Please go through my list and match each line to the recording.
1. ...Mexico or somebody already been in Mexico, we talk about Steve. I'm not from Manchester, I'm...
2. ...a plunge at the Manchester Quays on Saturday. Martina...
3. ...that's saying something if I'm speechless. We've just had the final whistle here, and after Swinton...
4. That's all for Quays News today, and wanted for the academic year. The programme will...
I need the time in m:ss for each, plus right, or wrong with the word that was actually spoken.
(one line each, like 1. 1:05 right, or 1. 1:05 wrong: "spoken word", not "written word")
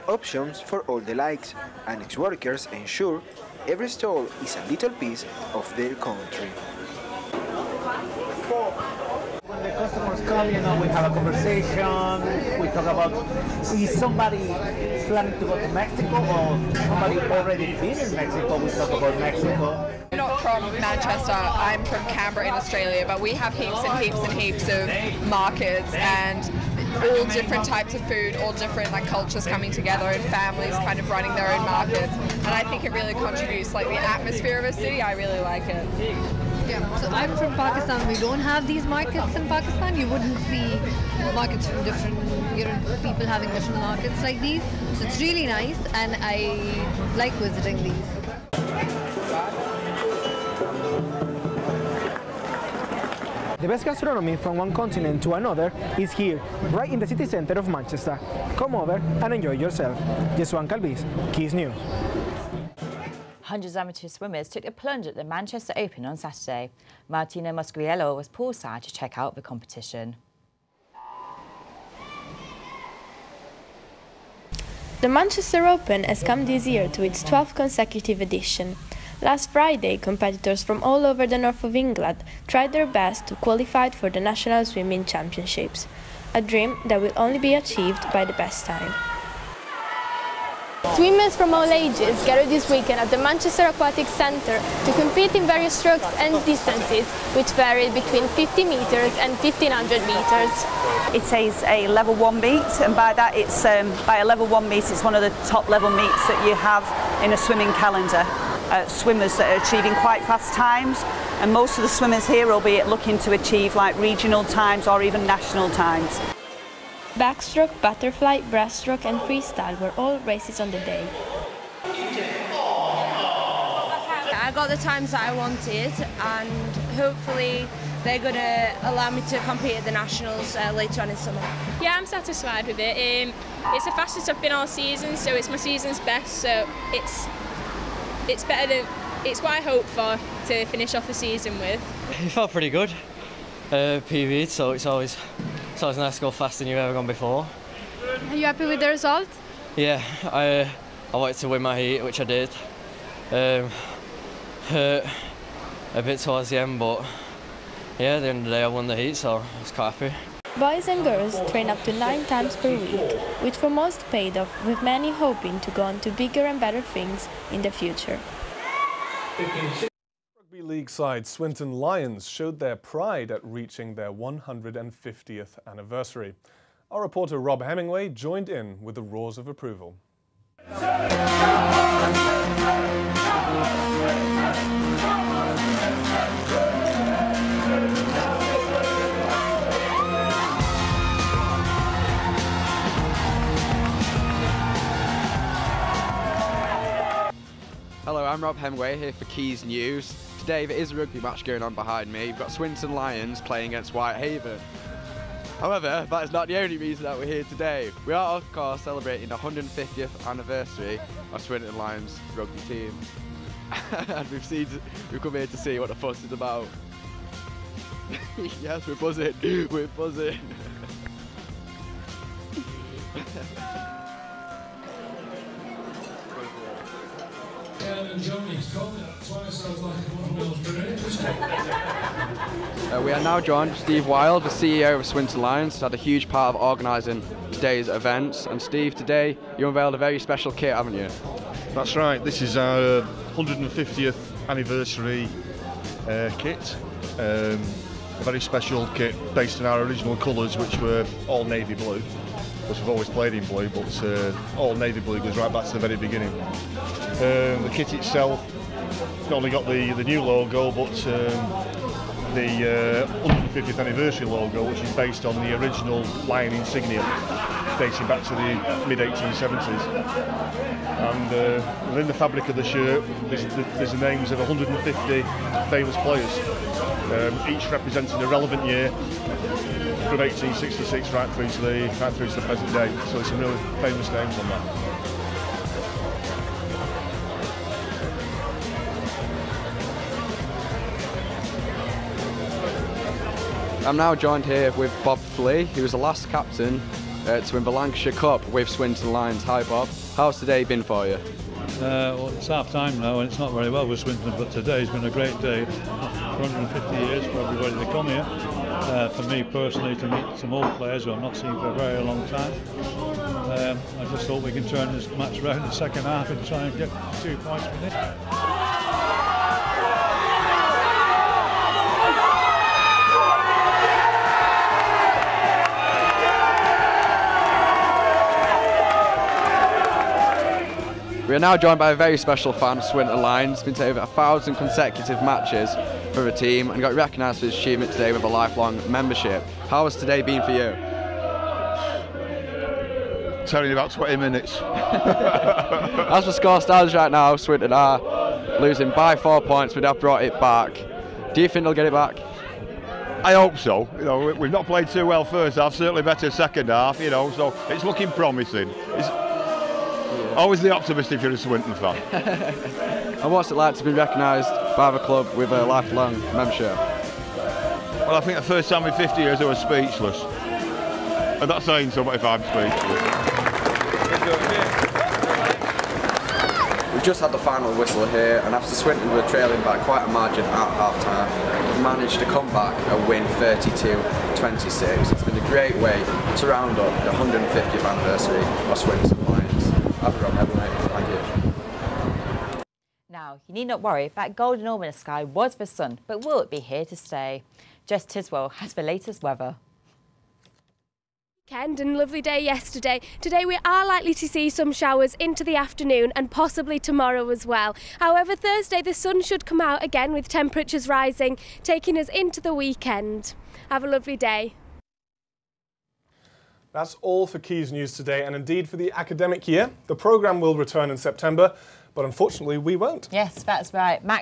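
1. 0:15 wrong: "Mexico", not "Steve"
2. 1:04 wrong: "Open", not "Quays"
3. 6:11 right
4. 6:56 wrong: "indeed", not "wanted".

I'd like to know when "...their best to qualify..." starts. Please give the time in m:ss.
1:22.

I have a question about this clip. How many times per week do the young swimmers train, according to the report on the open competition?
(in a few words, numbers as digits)
9.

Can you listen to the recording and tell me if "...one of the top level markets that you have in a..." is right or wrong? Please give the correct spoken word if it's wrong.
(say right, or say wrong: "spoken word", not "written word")
wrong: "meets", not "markets".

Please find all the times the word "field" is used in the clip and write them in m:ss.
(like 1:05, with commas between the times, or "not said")
not said.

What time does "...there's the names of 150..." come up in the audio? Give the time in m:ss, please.
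4:33.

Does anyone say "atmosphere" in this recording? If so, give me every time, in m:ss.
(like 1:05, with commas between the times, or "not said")
0:33.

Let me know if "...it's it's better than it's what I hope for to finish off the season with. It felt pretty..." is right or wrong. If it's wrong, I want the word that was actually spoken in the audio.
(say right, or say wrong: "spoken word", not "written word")
right.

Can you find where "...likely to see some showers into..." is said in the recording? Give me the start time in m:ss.
6:43.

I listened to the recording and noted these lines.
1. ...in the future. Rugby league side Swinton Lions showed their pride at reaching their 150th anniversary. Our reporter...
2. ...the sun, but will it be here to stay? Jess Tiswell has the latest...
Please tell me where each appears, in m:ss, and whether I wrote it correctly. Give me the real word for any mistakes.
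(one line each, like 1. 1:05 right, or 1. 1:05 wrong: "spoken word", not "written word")
1. 2:47 right
2. 6:35 right.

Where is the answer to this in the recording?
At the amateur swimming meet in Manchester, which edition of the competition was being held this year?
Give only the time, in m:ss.
1:17.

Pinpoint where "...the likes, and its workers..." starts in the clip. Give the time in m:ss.
0:00.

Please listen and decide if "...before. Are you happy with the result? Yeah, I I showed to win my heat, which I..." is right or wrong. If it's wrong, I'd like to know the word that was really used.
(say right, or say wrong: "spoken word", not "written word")
wrong: "wanted", not "showed".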